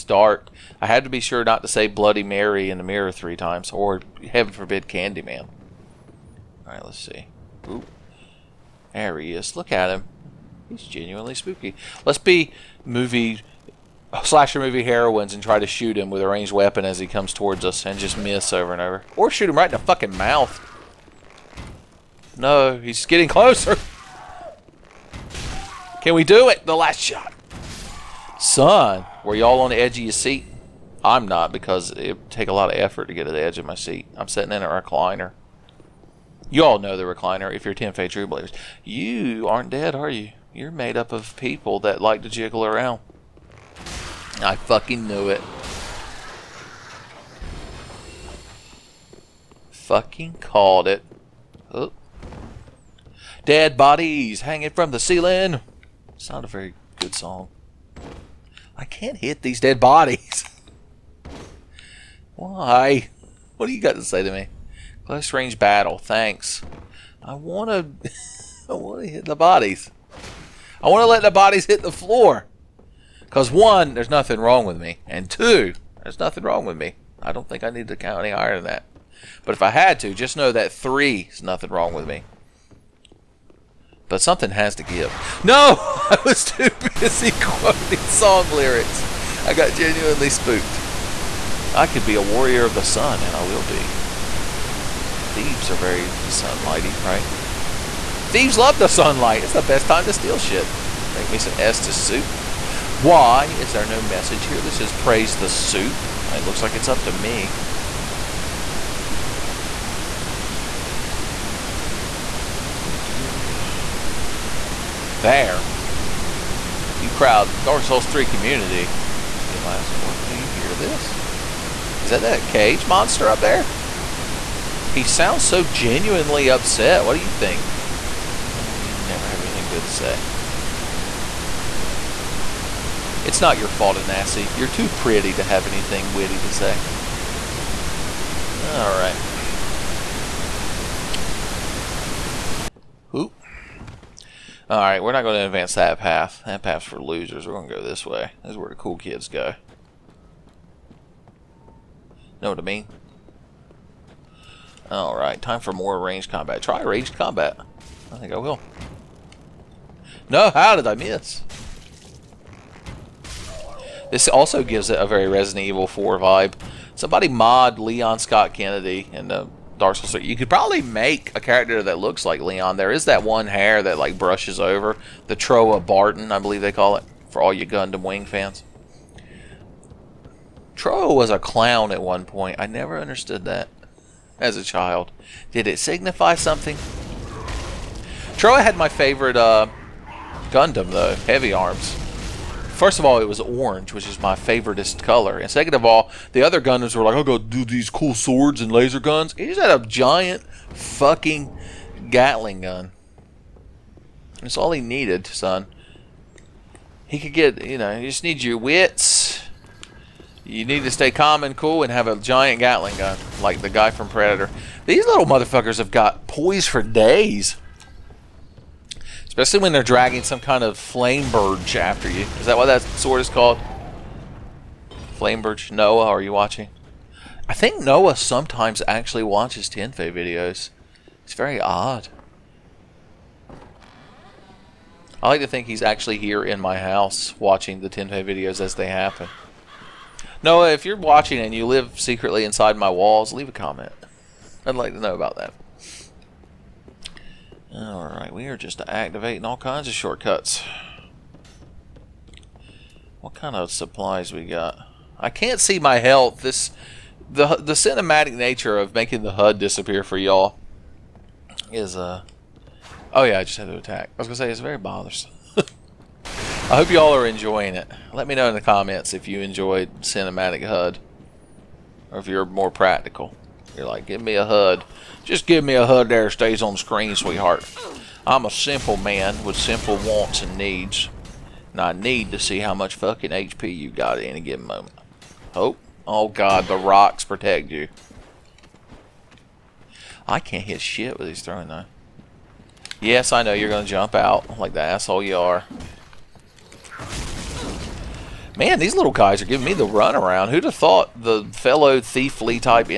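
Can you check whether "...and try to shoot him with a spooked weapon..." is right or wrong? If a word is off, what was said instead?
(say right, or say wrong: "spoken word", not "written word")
wrong: "ranged", not "spooked".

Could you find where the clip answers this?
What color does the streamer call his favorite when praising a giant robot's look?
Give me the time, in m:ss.
3:13.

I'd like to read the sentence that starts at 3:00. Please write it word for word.
Troa was a clown at one point.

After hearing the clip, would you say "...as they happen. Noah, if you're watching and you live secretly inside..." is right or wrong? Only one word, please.
right.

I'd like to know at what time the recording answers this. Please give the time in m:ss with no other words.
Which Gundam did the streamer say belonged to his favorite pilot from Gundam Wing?
3:11.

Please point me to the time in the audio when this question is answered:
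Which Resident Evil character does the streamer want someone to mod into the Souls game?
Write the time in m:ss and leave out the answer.
2:47.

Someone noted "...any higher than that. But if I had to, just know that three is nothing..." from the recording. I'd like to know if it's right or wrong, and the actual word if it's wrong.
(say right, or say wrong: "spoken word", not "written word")
right.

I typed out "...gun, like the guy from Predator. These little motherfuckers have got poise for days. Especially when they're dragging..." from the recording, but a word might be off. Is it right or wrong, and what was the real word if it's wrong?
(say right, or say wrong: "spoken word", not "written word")
right.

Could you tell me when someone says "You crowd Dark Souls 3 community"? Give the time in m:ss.
1:56.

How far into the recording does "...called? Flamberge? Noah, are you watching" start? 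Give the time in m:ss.
3:43.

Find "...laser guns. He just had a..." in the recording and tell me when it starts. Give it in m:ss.
3:18.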